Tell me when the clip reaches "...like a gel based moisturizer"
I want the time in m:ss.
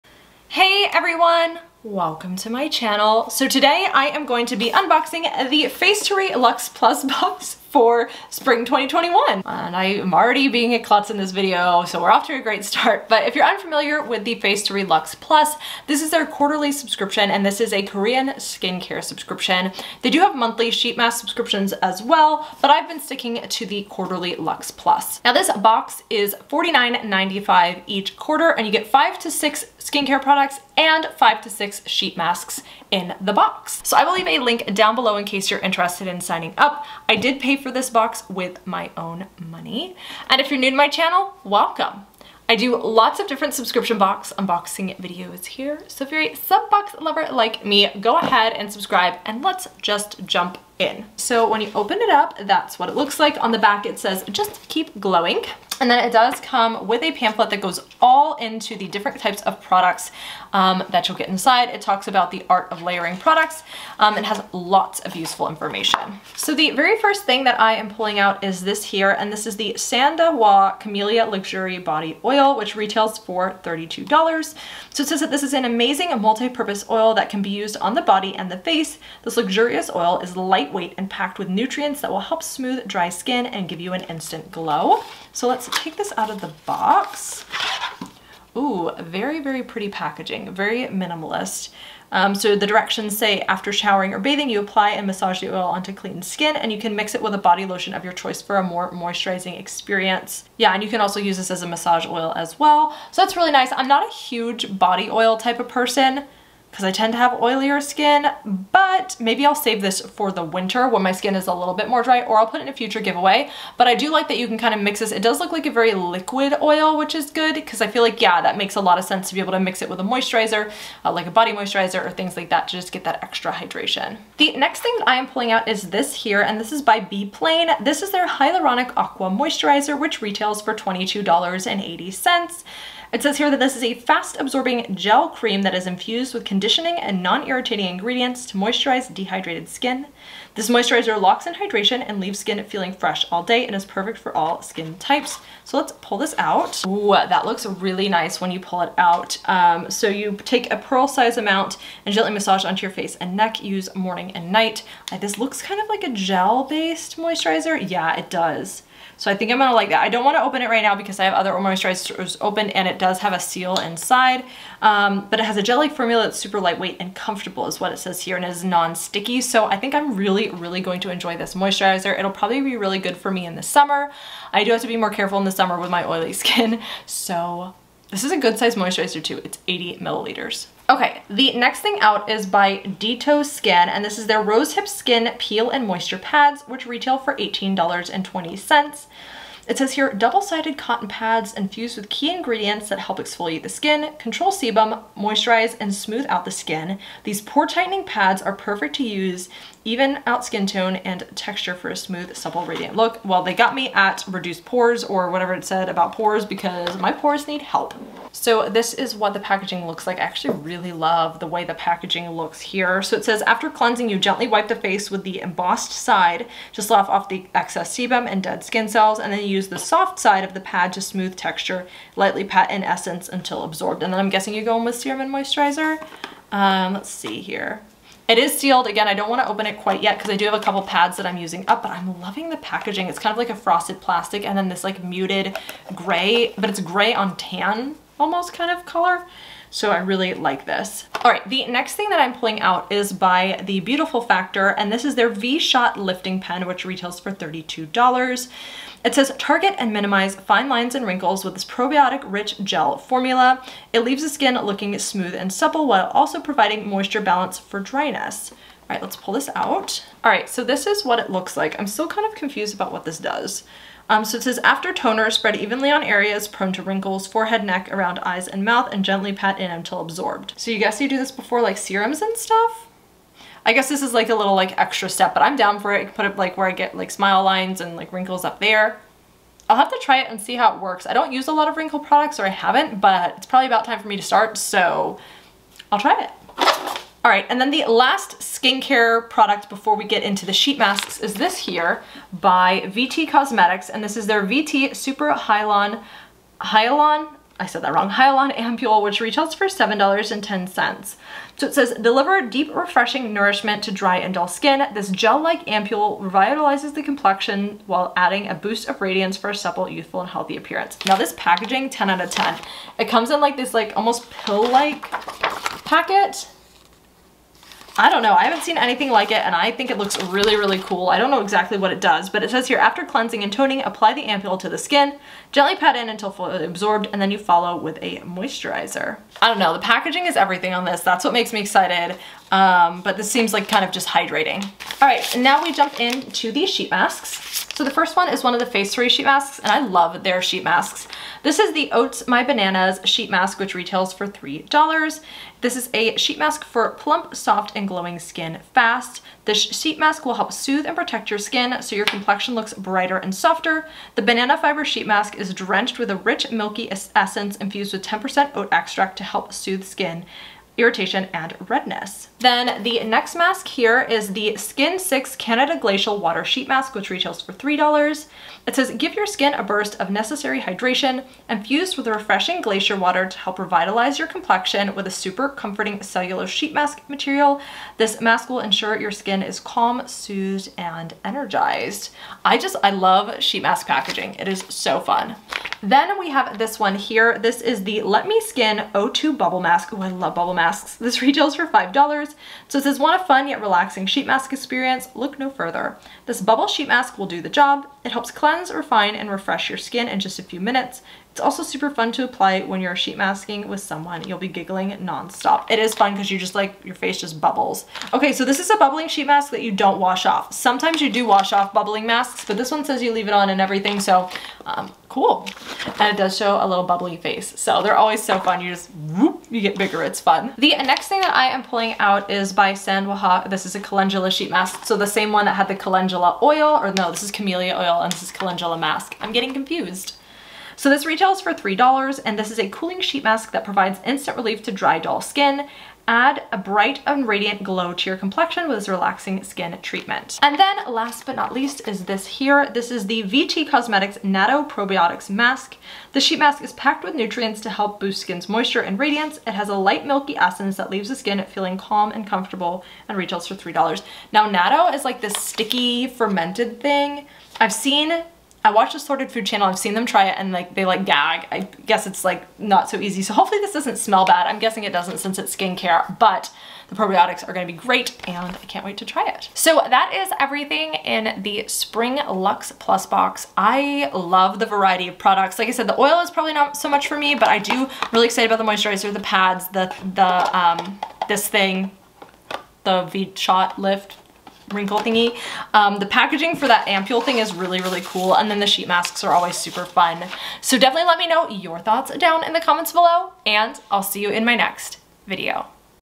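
2:35.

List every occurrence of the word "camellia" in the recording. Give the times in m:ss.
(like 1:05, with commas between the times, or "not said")
1:10, 7:07.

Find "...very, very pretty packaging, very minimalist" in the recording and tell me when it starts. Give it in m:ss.
1:28.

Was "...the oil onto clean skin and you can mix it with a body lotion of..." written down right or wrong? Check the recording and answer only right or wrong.
right.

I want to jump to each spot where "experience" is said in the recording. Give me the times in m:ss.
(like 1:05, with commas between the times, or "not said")
1:39, 6:34.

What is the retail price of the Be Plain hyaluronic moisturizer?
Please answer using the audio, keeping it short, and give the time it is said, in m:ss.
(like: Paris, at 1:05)
$22.80, at 2:10.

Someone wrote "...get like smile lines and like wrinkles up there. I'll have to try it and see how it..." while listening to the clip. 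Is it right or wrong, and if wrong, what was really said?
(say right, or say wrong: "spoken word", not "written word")
right.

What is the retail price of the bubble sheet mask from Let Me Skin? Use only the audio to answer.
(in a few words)
$5.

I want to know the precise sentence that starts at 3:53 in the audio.
It's kind of like a frosted plastic and then this like muted gray, but it's gray on tan almost kind of color.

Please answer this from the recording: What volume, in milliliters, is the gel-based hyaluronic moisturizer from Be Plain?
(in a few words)
80 milliliters.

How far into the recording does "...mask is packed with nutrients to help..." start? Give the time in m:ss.
7:26.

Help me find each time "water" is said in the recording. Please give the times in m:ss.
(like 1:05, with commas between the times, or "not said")
6:06, 6:12.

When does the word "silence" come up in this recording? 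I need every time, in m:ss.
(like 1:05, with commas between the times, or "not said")
not said.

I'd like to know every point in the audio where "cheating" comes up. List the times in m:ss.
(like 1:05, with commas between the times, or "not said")
not said.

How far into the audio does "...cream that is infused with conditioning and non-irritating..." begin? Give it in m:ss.
2:15.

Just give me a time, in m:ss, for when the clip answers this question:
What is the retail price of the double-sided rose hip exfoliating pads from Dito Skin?
3:07.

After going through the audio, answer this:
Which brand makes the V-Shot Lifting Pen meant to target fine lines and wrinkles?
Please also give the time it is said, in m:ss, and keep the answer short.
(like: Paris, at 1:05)
The Beautiful Factor, at 4:03.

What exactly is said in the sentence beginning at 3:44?
And then I'm guessing you go in with serum and moisturizer.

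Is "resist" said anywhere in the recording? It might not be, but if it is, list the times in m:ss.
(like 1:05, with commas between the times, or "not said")
not said.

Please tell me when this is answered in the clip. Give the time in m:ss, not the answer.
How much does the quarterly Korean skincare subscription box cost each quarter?
0:26.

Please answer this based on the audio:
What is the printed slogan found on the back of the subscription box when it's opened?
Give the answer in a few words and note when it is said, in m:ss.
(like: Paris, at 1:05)
just keep glowing, at 0:54.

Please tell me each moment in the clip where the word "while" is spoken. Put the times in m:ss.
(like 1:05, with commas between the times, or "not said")
4:15, 5:07.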